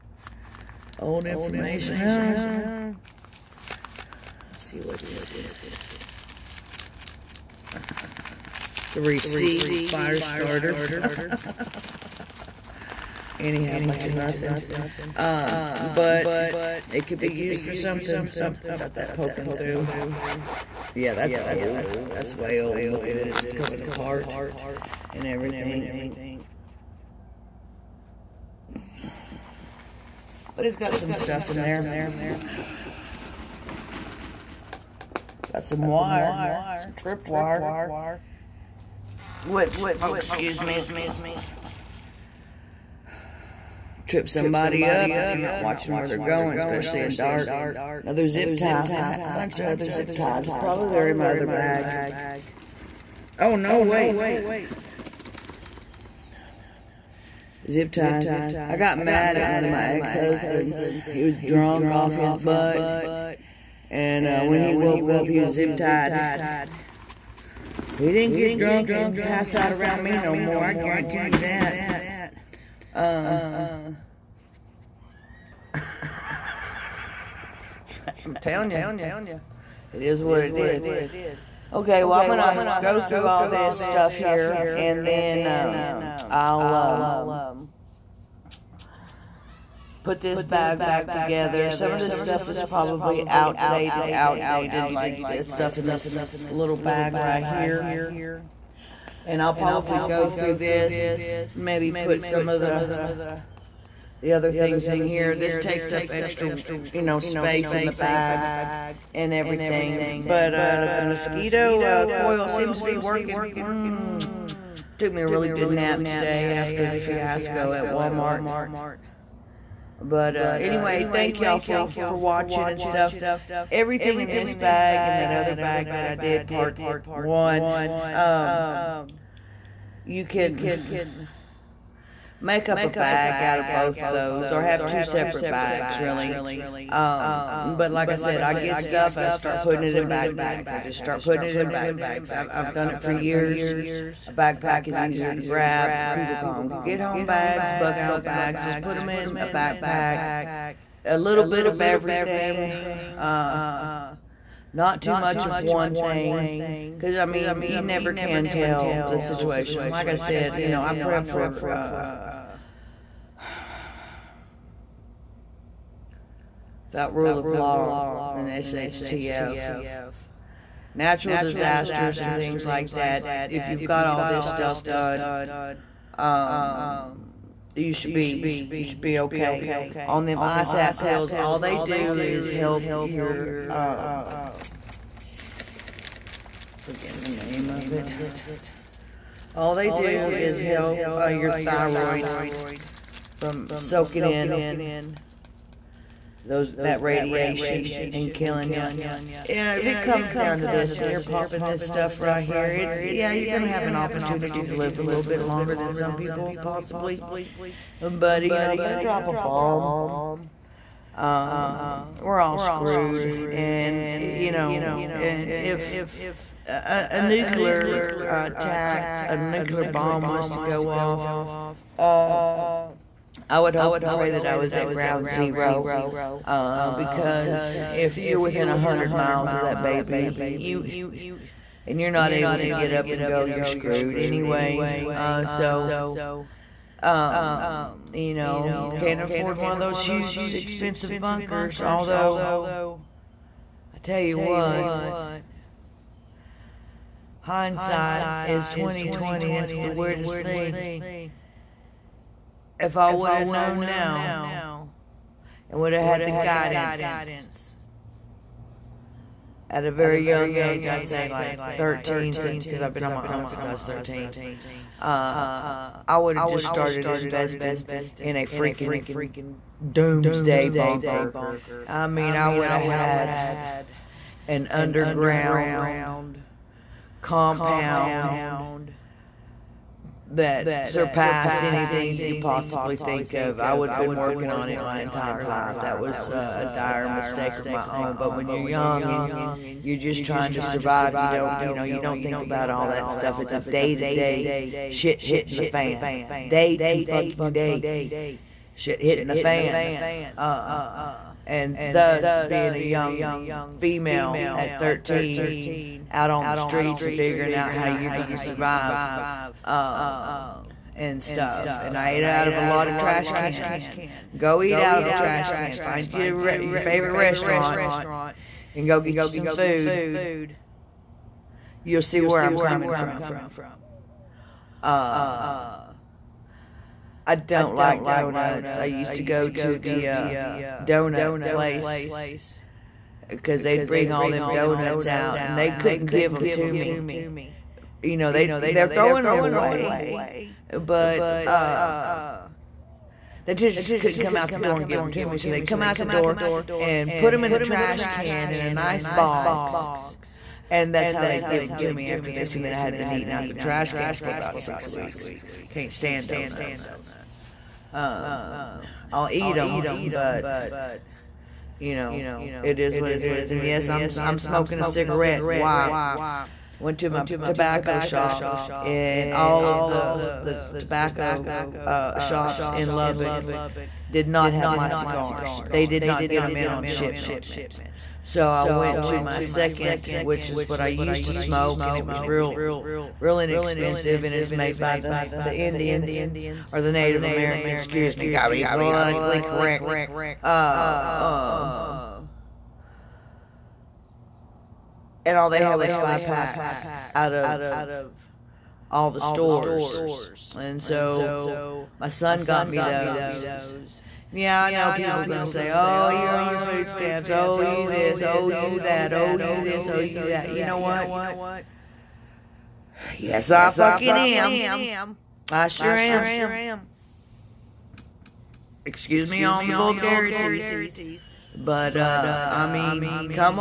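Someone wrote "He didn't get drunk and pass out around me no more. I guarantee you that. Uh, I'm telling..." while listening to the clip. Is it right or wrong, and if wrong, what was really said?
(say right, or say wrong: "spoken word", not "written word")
right.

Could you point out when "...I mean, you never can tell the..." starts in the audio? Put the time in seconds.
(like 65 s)
157 s.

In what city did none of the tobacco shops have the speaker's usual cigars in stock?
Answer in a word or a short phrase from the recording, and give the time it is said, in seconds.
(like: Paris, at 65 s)
Lubbock, at 372 s.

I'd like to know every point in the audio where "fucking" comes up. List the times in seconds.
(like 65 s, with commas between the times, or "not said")
297 s, 413 s.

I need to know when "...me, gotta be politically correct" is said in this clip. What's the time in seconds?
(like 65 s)
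388 s.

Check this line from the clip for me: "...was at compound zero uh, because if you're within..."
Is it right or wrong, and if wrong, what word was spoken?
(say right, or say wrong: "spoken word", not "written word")
wrong: "ground", not "compound".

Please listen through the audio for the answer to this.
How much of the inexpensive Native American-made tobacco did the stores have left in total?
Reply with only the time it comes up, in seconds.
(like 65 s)
395 s.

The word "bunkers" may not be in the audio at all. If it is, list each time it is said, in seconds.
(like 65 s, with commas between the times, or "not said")
241 s, 270 s.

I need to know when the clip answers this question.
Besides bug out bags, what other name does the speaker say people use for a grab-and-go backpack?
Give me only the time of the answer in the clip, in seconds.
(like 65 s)
146 s.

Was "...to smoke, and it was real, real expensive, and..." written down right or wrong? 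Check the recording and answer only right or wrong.
wrong.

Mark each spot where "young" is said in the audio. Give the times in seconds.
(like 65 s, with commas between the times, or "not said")
260 s, 288 s, 302 s.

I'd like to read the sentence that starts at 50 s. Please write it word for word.
Probably they're in my other bag.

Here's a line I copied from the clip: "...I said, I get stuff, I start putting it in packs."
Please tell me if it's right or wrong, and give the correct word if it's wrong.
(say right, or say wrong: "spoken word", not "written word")
wrong: "backpacks", not "packs".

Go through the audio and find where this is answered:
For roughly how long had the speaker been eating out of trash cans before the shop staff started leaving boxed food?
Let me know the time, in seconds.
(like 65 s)
354 s.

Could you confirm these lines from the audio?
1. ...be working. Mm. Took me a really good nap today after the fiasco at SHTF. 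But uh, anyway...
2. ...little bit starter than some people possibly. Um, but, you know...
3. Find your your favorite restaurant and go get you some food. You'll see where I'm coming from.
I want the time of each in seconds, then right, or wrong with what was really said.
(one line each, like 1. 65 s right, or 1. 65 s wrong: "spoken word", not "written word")
1. 112 s wrong: "Walmart", not "SHTF"
2. 205 s wrong: "longer", not "starter"
3. 315 s right.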